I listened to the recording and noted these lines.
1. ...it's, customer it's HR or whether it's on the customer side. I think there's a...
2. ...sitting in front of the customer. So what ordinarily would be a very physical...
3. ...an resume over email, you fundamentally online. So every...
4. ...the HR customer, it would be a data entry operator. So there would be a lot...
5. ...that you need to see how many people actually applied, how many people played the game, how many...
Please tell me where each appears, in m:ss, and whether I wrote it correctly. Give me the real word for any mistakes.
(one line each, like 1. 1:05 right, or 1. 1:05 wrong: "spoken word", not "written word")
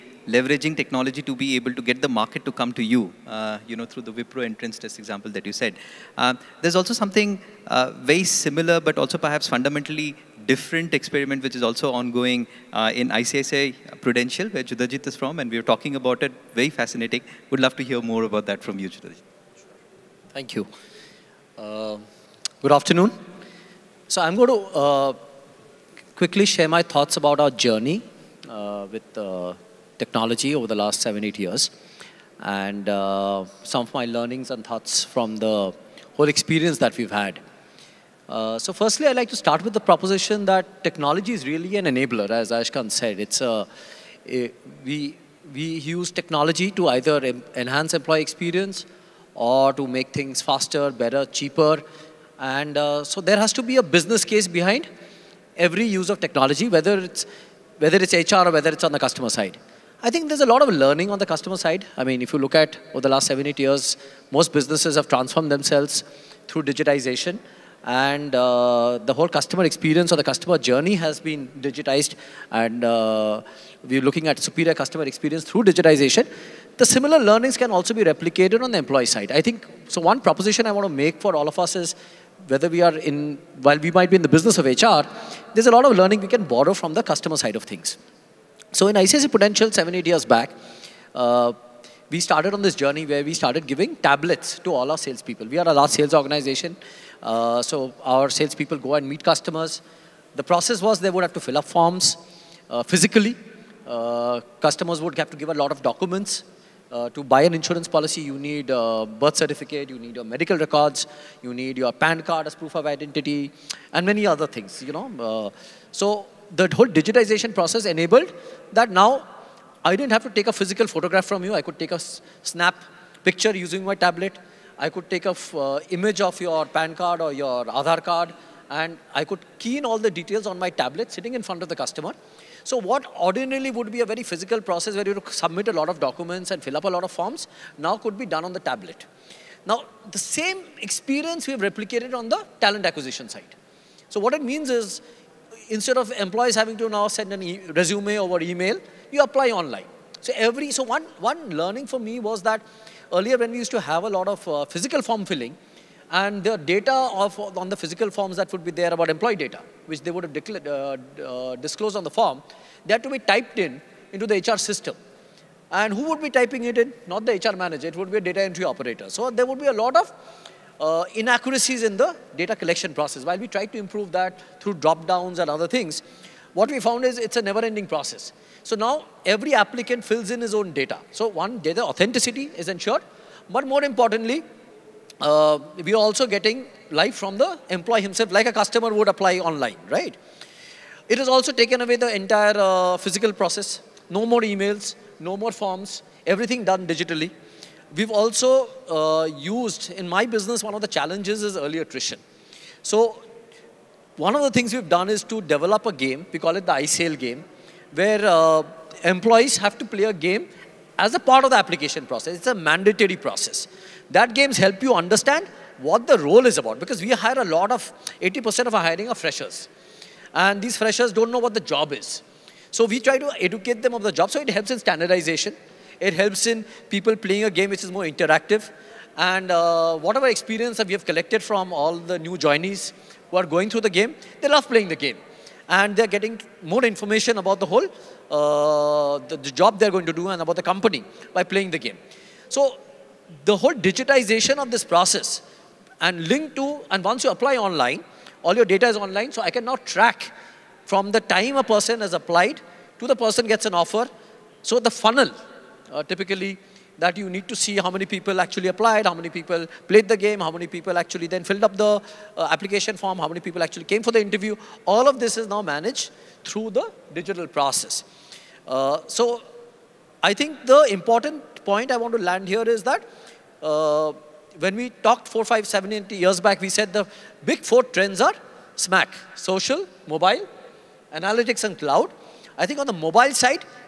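1. 0:56 wrong: "whether", not "customer"
2. 2:11 right
3. 2:27 wrong: "apply", not "fundamentally"
4. 2:47 wrong: "manager", not "customer"
5. 4:16 right.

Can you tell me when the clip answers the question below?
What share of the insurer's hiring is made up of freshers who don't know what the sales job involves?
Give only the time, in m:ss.
3:38.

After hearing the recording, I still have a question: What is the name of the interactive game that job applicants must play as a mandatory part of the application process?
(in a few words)
iSale game.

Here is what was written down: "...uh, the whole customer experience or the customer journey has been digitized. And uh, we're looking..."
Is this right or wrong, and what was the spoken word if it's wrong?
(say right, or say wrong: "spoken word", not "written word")
right.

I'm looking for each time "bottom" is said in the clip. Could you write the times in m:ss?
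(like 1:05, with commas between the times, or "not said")
not said.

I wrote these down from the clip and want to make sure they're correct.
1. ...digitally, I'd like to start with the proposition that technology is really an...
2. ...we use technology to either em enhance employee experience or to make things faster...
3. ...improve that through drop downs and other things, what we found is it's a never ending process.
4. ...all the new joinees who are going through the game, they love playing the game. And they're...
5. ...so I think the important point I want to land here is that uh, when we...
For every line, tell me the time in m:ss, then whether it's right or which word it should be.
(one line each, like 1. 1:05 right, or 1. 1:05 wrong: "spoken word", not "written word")
1. 0:38 wrong: "firstly", not "digitally"
2. 0:45 right
3. 2:53 right
4. 3:51 right
5. 4:29 right.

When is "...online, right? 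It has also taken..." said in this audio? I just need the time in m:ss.
3:09.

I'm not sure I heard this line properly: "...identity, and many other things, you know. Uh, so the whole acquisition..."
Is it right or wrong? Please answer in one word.
wrong.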